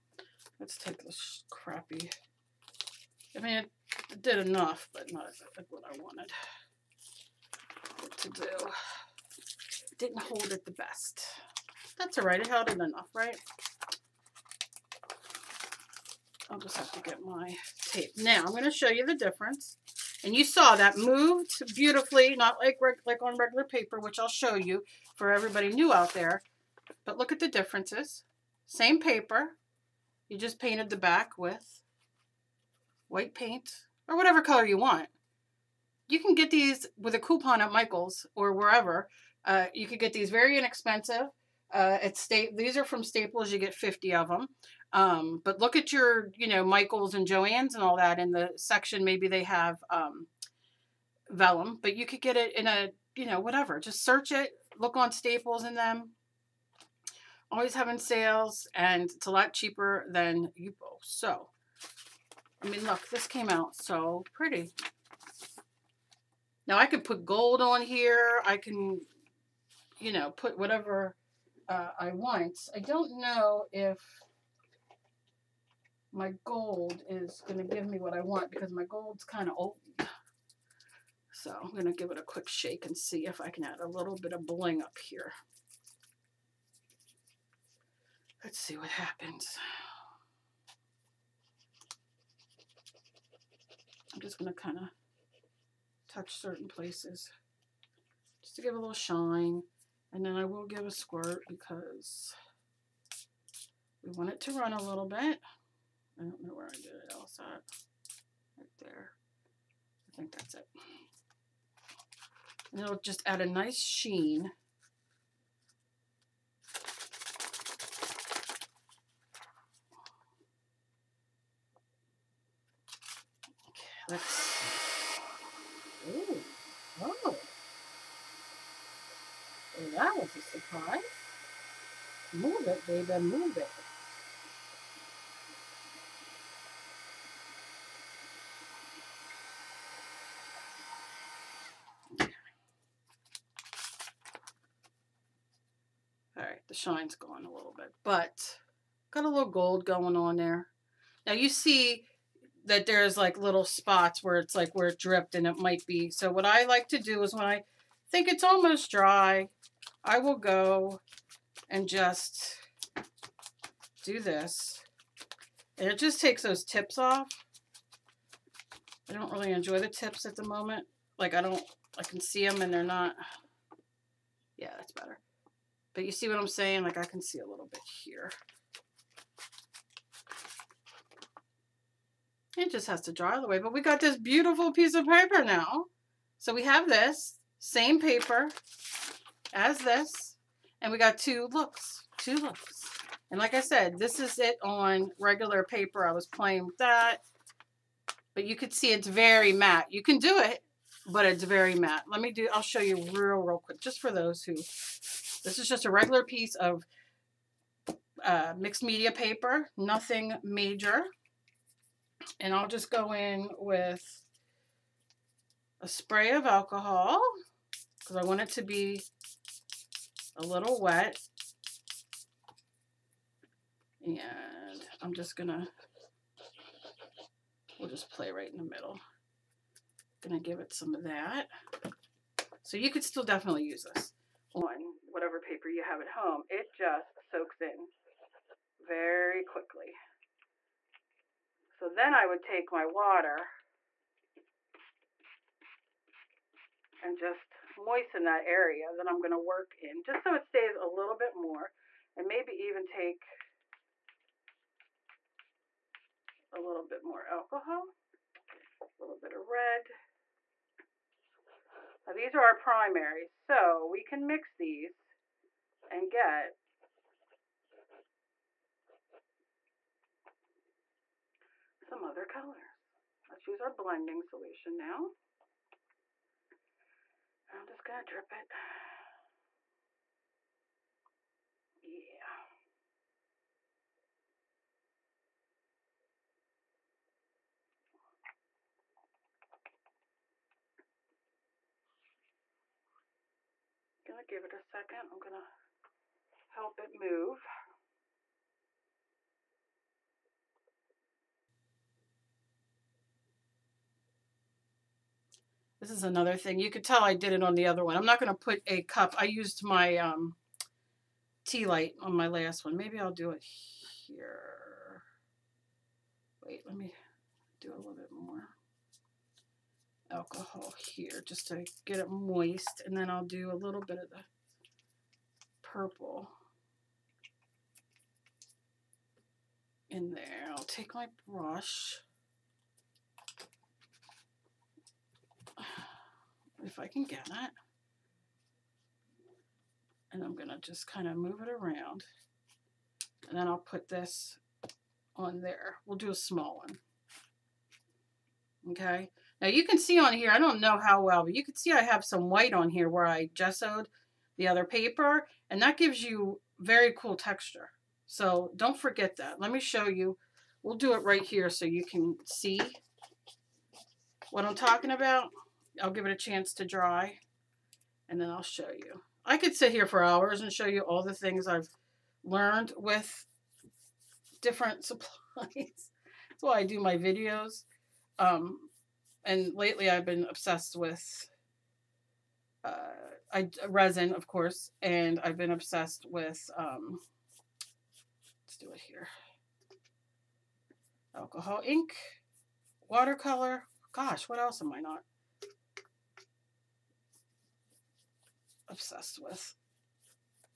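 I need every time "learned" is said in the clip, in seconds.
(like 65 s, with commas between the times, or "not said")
372 s.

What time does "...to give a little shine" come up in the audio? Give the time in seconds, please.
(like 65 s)
98 s.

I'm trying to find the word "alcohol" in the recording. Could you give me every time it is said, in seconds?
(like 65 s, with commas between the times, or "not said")
216 s, 257 s, 320 s, 391 s.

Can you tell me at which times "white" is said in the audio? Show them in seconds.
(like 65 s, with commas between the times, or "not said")
33 s, 352 s.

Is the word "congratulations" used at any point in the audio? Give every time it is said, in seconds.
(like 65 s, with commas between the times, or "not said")
not said.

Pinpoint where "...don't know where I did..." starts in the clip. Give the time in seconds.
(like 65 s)
106 s.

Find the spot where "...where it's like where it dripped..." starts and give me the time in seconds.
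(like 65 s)
154 s.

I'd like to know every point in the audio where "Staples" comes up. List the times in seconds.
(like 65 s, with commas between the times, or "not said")
43 s, 55 s.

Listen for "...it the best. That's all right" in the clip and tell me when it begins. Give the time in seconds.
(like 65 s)
10 s.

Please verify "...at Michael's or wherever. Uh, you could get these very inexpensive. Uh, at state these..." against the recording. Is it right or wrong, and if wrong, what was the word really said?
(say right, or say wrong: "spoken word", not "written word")
right.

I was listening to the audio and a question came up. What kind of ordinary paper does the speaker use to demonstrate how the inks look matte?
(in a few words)
Mixed media paper.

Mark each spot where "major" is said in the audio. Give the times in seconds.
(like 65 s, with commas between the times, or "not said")
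210 s.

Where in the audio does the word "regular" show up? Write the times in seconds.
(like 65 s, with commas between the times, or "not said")
23 s, 195 s, 205 s.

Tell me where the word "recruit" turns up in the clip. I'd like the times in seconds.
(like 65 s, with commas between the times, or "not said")
not said.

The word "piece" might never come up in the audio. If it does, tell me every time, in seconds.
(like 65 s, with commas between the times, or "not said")
184 s, 206 s.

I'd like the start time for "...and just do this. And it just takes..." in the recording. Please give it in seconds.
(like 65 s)
161 s.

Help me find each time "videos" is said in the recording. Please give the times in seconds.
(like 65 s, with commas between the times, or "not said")
376 s.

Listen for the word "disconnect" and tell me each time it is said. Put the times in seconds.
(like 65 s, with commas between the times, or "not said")
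not said.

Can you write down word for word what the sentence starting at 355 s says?
And that gives you very cool texture.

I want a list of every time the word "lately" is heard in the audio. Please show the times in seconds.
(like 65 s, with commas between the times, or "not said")
379 s.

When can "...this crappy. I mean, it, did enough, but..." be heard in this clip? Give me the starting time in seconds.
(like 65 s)
1 s.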